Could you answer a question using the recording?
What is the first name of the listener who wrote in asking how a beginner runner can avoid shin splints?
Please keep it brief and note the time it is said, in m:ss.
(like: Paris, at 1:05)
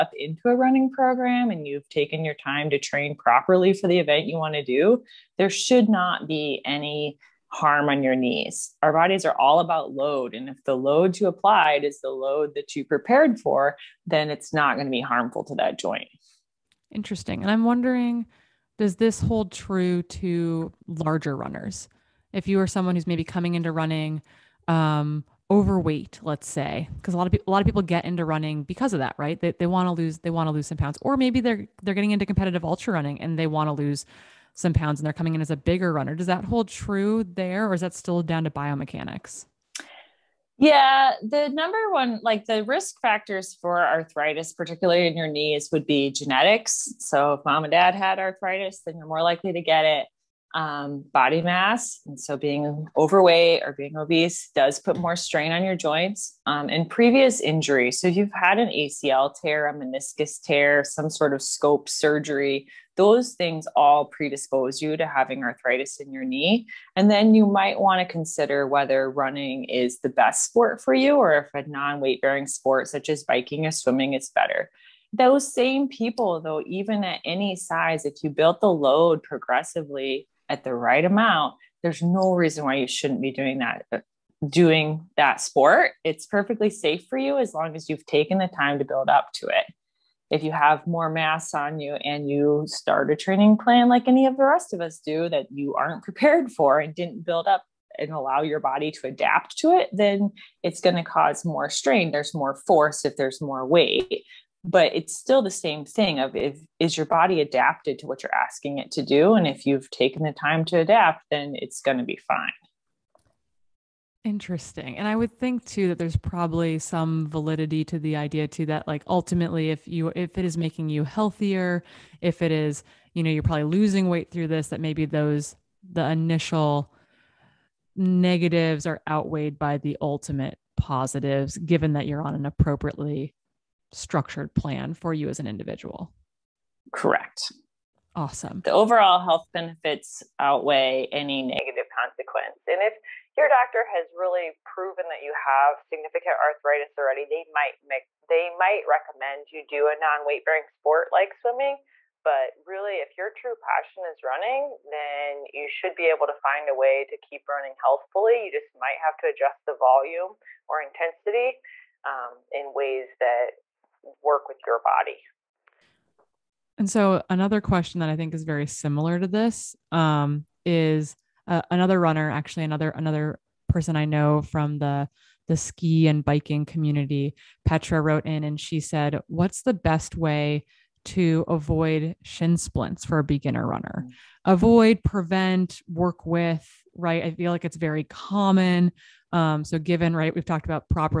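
Petra, at 2:57.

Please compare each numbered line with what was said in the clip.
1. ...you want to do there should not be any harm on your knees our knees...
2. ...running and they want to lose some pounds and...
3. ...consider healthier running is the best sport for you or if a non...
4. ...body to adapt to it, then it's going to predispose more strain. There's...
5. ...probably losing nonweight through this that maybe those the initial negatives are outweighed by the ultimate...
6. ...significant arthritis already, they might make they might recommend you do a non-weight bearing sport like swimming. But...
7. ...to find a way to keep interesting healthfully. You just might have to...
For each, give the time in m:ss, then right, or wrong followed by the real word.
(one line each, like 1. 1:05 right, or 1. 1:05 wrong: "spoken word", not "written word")
1. 0:04 wrong: "bodies", not "knees"
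2. 0:32 right
3. 1:08 wrong: "whether", not "healthier"
4. 1:38 wrong: "cause", not "predispose"
5. 2:03 wrong: "weight", not "nonweight"
6. 2:25 right
7. 2:36 wrong: "running", not "interesting".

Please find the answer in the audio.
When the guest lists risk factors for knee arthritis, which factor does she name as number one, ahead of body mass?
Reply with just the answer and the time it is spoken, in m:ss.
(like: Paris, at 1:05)
Genetics, at 0:46.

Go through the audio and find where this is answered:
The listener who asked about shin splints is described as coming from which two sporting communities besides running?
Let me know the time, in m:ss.
2:55.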